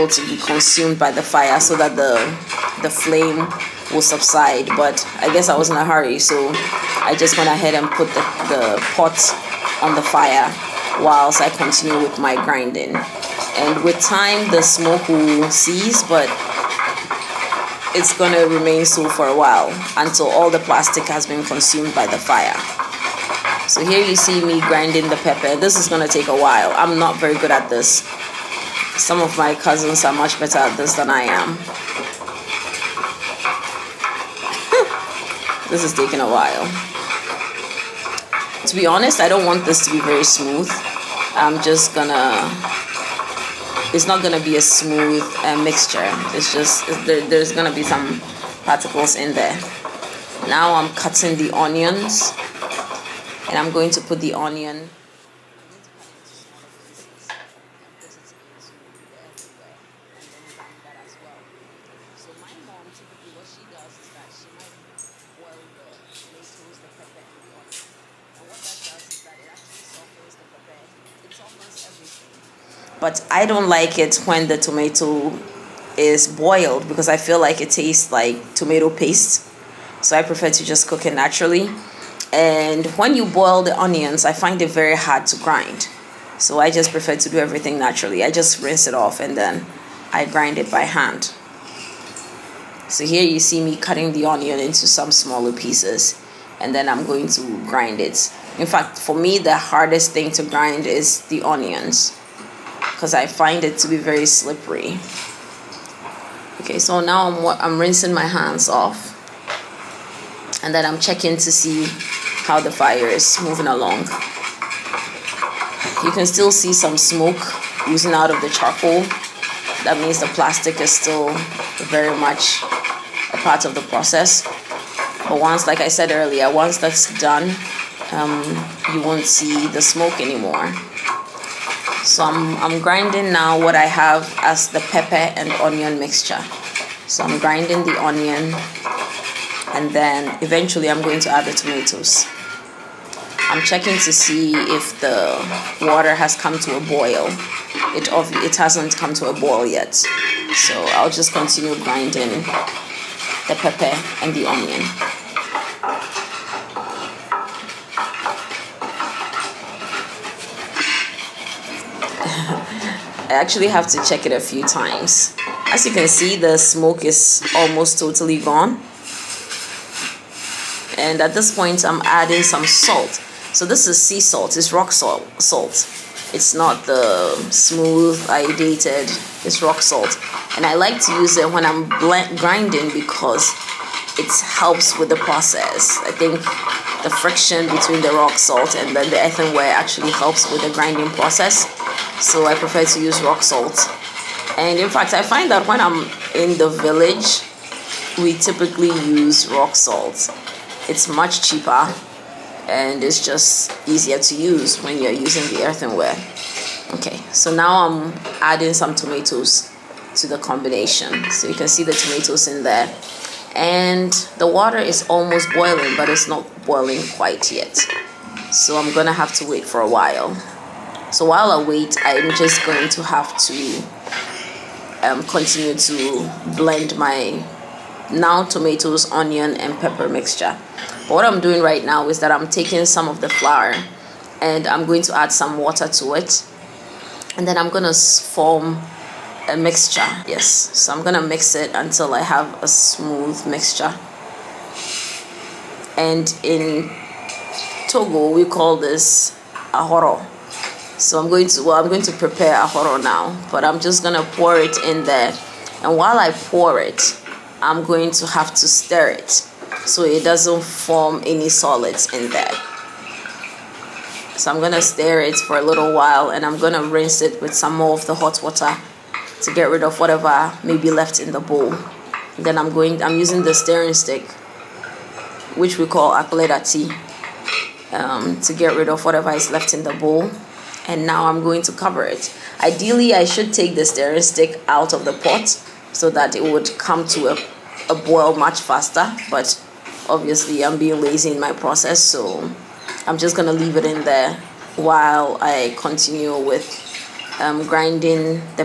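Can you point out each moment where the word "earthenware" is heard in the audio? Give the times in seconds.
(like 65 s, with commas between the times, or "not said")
189 s, 205 s.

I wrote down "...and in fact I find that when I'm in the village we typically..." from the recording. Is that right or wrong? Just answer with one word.
right.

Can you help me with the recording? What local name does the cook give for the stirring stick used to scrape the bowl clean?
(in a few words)
Akuleta.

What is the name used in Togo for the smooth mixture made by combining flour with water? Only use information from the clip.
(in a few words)
Ahoro.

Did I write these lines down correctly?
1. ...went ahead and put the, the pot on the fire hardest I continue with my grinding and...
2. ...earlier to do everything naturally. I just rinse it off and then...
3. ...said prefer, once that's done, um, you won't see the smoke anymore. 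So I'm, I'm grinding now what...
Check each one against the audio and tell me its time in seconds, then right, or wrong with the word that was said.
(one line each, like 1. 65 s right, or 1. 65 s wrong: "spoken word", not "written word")
1. 7 s wrong: "whilst", not "hardest"
2. 86 s wrong: "prefer", not "earlier"
3. 125 s wrong: "earlier", not "prefer".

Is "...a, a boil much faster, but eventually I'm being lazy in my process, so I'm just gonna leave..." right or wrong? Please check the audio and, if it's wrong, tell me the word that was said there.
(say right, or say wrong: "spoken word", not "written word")
wrong: "obviously", not "eventually".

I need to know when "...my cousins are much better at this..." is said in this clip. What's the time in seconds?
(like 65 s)
29 s.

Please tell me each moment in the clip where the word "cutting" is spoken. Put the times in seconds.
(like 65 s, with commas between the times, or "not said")
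50 s, 93 s.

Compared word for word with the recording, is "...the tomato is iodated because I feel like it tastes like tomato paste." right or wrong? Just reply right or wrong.
wrong.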